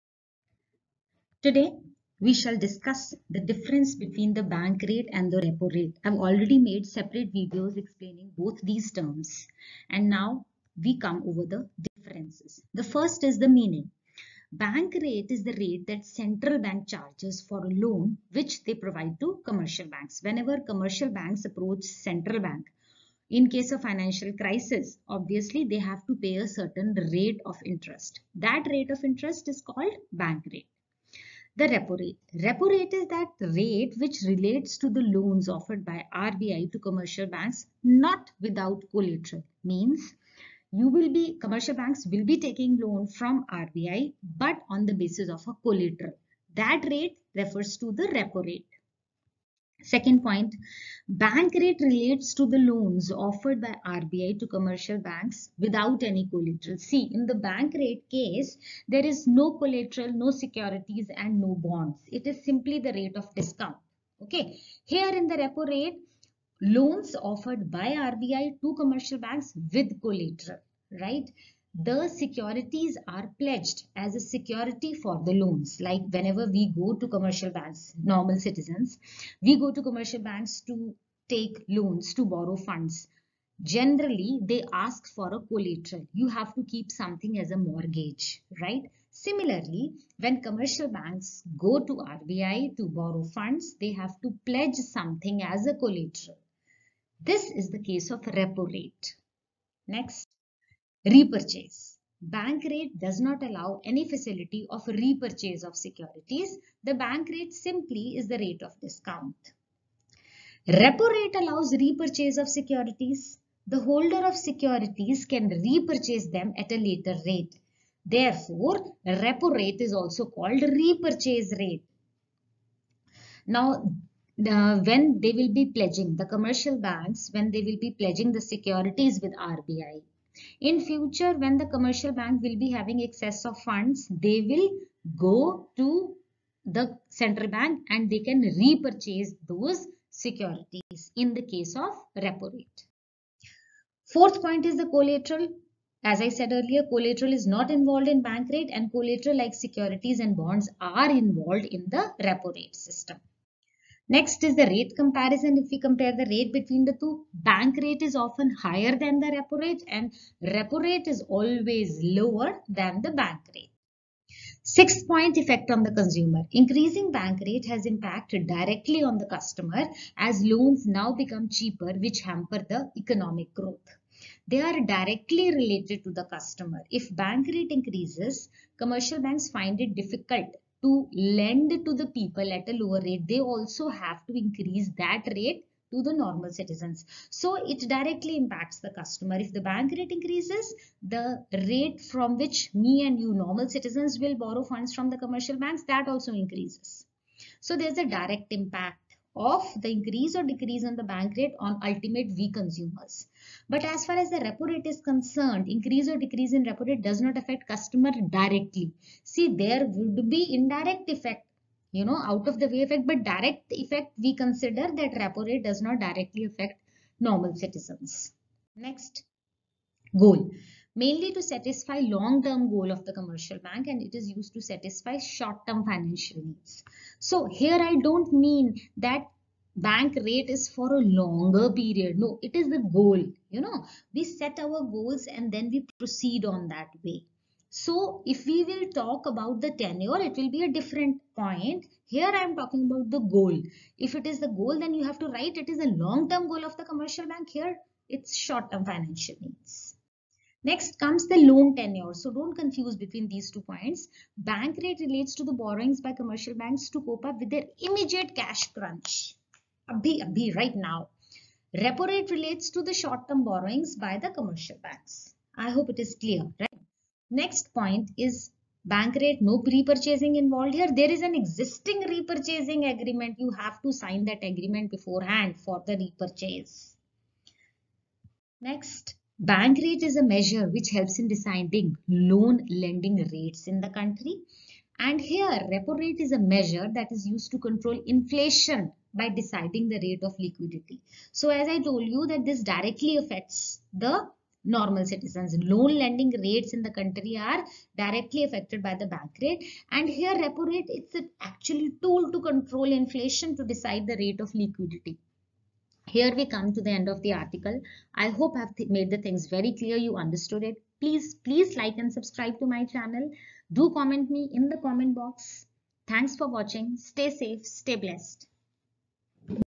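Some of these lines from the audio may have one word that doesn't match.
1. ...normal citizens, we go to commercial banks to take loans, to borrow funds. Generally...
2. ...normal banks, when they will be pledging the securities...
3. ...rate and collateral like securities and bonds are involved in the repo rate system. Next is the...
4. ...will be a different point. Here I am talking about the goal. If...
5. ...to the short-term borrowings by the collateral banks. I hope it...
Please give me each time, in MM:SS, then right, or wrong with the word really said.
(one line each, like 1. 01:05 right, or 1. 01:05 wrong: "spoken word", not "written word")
1. 01:18 right
2. 02:06 wrong: "commercial", not "normal"
3. 02:28 right
4. 04:00 right
5. 04:22 wrong: "commercial", not "collateral".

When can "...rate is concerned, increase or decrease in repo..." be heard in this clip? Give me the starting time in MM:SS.
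03:24.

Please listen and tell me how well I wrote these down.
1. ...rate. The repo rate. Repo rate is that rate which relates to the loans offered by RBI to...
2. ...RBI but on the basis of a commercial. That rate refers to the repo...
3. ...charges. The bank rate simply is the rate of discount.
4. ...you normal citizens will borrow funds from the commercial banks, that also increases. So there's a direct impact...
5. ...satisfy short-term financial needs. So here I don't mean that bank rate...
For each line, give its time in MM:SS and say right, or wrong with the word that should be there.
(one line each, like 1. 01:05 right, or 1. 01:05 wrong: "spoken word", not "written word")
1. 00:30 right
2. 00:43 wrong: "collateral", not "commercial"
3. 01:45 wrong: "securities", not "charges"
4. 03:13 right
5. 03:44 right.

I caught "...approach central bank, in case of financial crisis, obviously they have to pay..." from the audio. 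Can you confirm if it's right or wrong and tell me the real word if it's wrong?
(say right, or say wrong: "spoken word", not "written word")
right.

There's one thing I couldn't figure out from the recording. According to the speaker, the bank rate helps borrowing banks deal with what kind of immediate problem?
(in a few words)
Cash crunch.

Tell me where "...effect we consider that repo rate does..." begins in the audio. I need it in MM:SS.
03:33.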